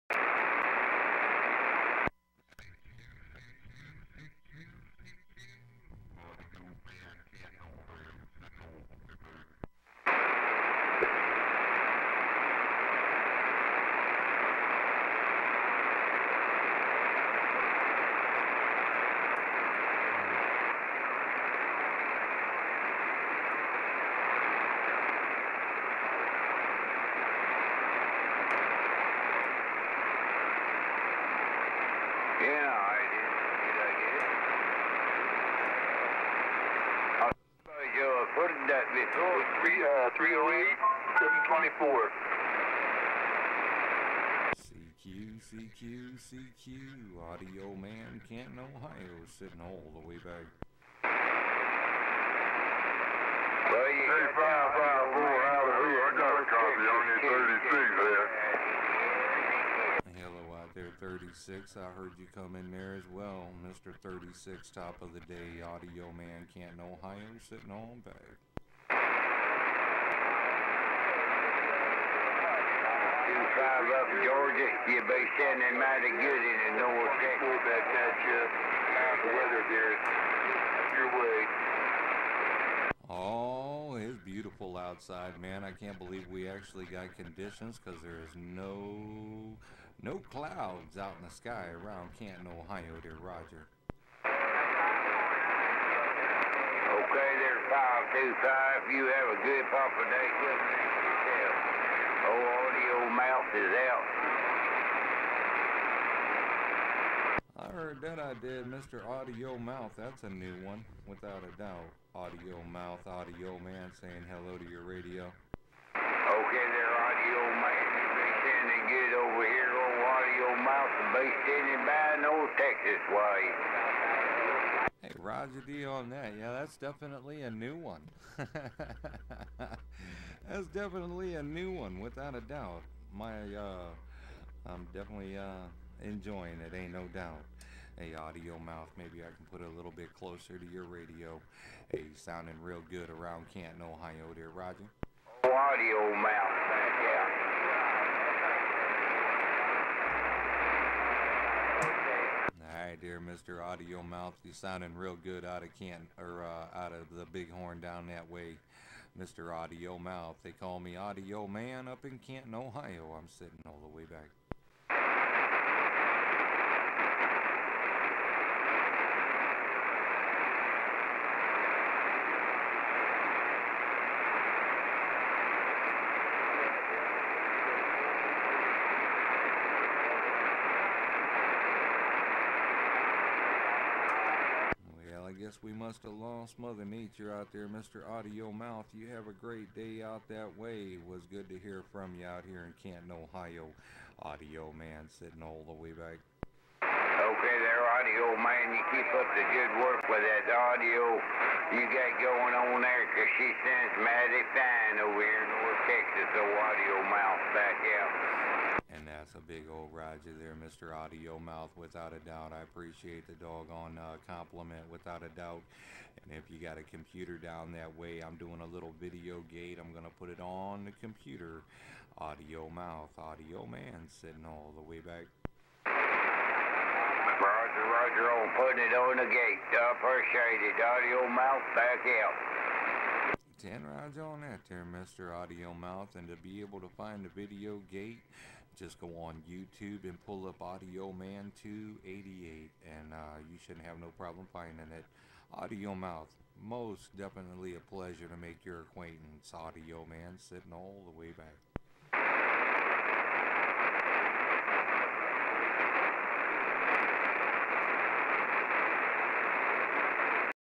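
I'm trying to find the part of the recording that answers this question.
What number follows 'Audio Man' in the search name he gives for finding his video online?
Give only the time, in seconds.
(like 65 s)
241 s.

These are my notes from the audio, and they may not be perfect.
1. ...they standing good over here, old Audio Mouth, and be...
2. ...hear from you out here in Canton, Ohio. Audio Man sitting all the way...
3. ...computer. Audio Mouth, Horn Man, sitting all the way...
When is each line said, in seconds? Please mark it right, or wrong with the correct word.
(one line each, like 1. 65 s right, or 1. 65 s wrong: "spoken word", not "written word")
1. 118 s right
2. 191 s right
3. 221 s wrong: "Audio", not "Horn".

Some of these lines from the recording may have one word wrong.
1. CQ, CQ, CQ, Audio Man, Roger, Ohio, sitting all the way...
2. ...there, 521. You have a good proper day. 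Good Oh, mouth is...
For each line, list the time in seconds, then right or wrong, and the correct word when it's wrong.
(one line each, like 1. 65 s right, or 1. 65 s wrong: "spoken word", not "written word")
1. 44 s wrong: "Canton", not "Roger"
2. 97 s wrong: "525", not "521".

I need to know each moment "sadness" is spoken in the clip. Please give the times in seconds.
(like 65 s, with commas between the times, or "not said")
not said.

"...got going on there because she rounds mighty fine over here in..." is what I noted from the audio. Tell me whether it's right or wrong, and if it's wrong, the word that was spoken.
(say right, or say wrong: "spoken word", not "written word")
wrong: "sounds", not "rounds".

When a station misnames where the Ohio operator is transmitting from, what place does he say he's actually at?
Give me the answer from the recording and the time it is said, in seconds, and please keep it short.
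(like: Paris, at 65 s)
Big Horn, at 157 s.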